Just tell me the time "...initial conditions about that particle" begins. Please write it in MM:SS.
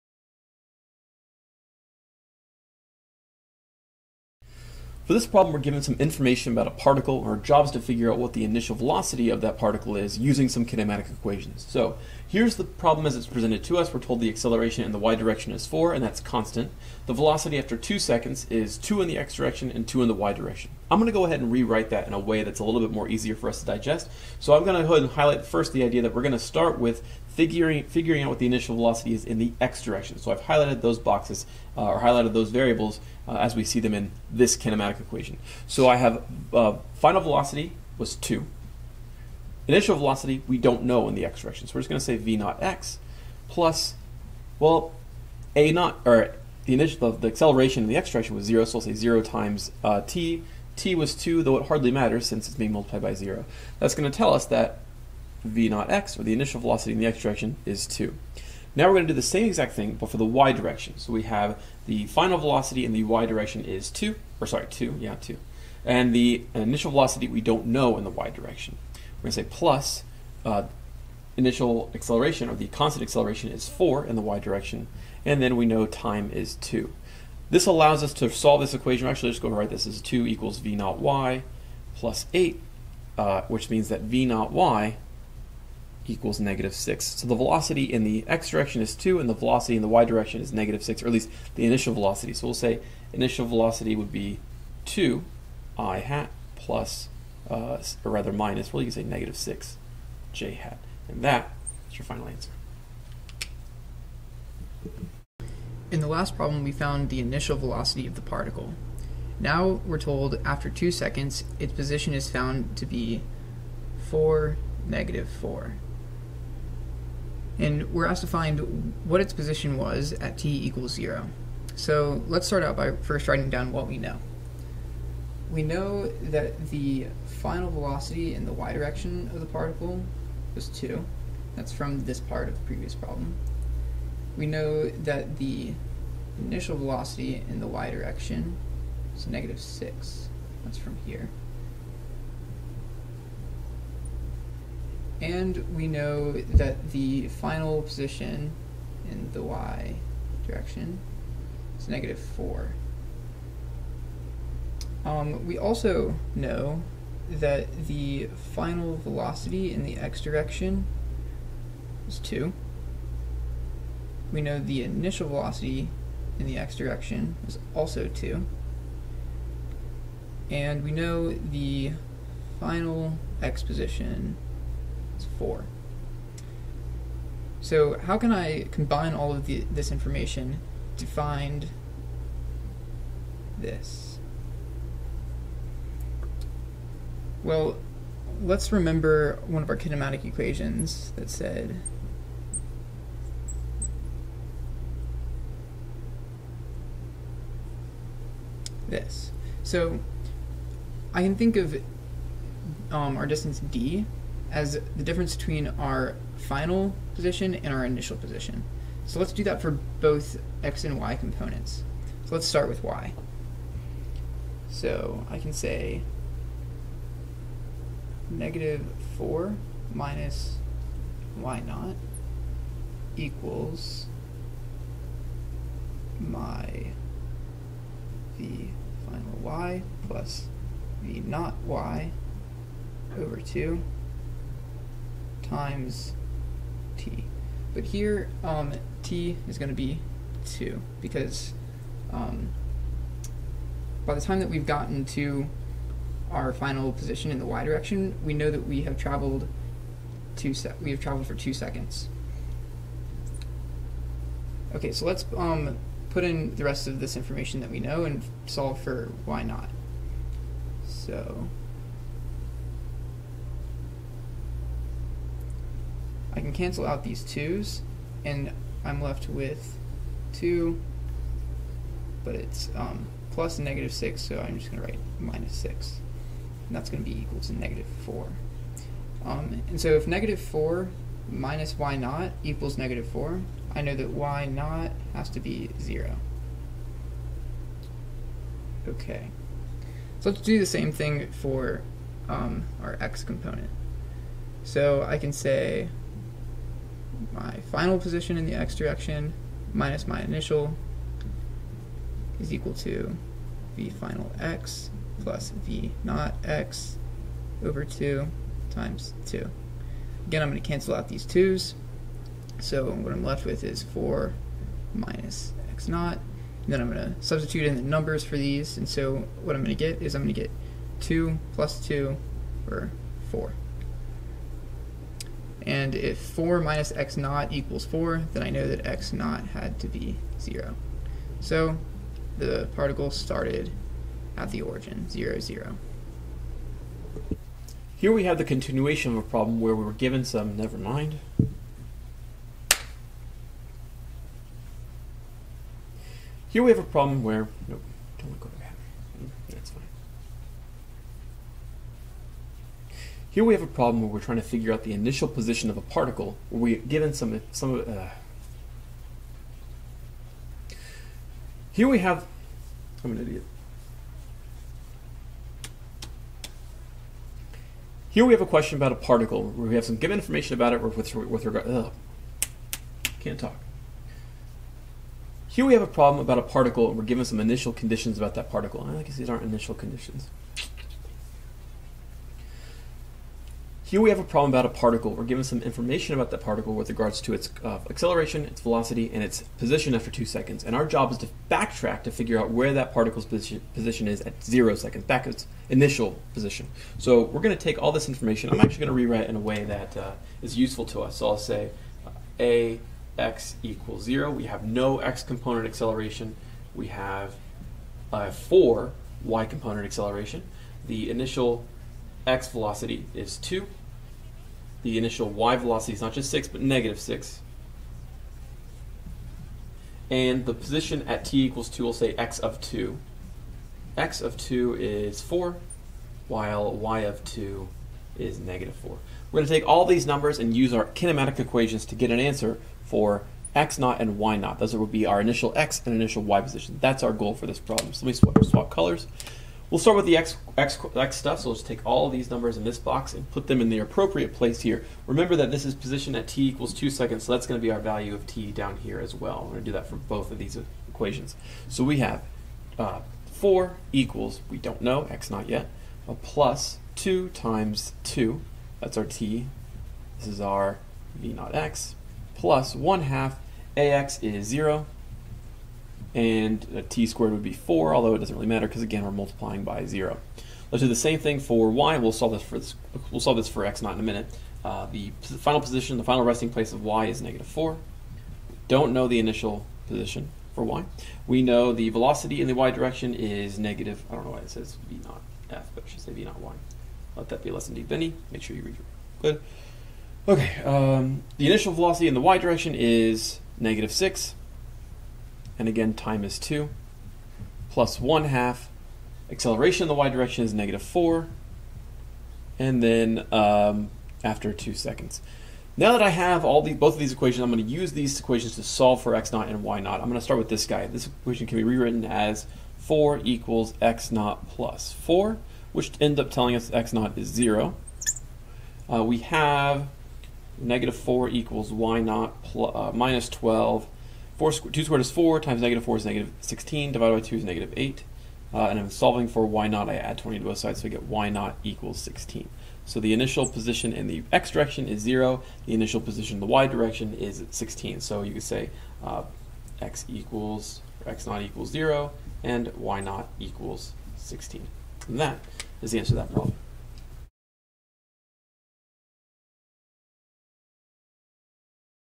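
06:17.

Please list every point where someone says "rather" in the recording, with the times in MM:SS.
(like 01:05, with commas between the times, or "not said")
01:38.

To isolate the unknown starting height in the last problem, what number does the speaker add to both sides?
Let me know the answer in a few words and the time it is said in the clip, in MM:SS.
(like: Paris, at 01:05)
20, at 08:49.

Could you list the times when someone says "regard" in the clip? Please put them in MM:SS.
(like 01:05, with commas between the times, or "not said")
06:11, 06:26.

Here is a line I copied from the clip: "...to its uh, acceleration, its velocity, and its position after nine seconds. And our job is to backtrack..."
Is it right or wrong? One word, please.
wrong.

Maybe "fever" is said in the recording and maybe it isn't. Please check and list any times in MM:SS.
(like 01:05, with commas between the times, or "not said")
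not said.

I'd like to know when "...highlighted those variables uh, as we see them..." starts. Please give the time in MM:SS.
00:31.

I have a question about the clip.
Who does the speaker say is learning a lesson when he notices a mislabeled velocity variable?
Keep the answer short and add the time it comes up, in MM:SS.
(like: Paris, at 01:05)
Benny, at 08:07.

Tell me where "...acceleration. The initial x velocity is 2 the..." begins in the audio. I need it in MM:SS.
06:49.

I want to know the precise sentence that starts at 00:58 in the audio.
Now we're going to do the same exact thing, but for the y direction.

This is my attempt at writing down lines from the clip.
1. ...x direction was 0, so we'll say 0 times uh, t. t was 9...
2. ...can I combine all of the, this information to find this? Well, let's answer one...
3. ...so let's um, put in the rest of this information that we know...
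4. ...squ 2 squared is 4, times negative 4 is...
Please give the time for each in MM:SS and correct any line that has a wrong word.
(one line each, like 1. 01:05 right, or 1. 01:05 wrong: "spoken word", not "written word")
1. 00:47 wrong: "2", not "9"
2. 02:58 wrong: "remember", not "answer"
3. 04:14 right
4. 08:44 right.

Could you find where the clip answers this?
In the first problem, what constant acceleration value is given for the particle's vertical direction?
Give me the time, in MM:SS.
00:14.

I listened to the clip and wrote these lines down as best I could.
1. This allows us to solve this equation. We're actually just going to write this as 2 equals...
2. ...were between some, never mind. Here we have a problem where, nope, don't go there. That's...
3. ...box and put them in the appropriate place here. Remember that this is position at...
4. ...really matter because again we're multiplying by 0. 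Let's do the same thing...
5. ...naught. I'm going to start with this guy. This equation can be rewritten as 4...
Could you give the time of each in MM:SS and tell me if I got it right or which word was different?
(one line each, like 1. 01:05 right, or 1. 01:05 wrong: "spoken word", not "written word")
1. 01:17 right
2. 05:39 wrong: "given", not "between"
3. 07:22 right
4. 07:48 right
5. 08:29 right.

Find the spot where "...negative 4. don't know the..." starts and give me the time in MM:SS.
07:57.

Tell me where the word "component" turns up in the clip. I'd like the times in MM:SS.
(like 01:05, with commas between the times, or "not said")
03:31, 04:53, 06:45, 06:49.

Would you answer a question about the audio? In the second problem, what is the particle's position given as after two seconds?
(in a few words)
4, -4.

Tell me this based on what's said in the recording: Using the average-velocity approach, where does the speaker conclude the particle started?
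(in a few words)
The origin.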